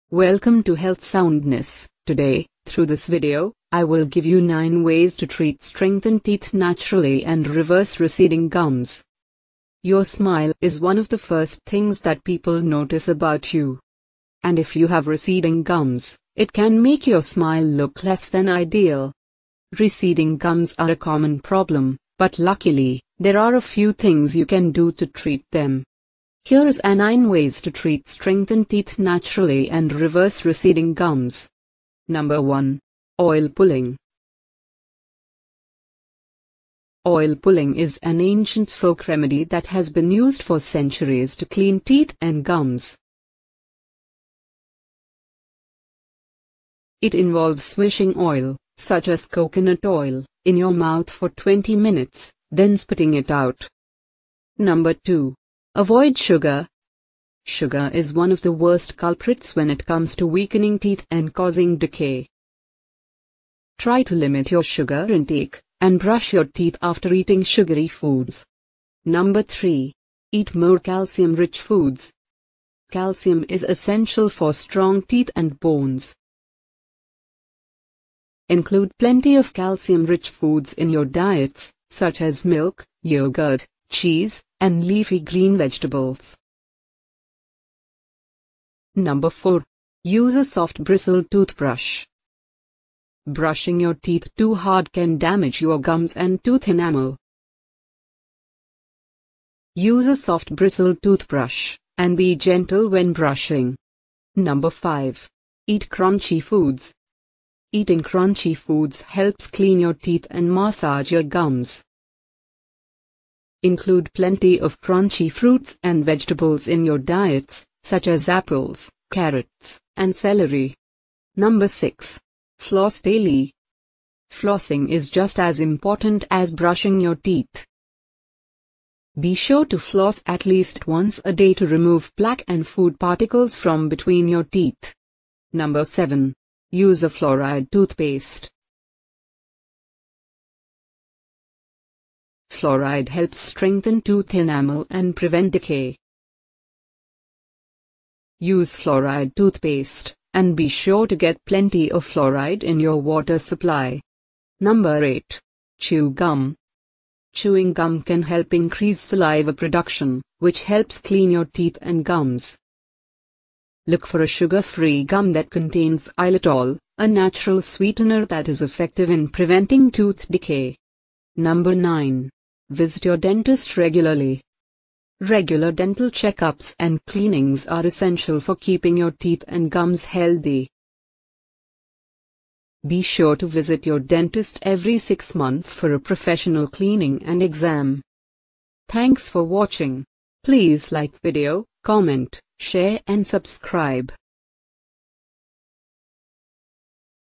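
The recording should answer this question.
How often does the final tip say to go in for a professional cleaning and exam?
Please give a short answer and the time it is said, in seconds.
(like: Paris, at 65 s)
Every 6 months, at 184 s.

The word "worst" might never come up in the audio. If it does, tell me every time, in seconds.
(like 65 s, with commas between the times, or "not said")
58 s.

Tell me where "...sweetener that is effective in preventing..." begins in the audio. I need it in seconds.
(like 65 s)
167 s.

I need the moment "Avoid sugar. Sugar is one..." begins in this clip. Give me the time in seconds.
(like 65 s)
55 s.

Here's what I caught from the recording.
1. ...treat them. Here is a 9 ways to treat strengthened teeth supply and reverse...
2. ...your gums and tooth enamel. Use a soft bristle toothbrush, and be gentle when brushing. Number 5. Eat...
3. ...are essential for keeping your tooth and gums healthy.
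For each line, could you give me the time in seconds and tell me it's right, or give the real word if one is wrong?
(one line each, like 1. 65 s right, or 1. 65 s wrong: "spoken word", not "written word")
1. 25 s wrong: "naturally", not "supply"
2. 95 s right
3. 177 s wrong: "teeth", not "tooth".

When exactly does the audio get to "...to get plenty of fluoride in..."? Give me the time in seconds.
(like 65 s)
151 s.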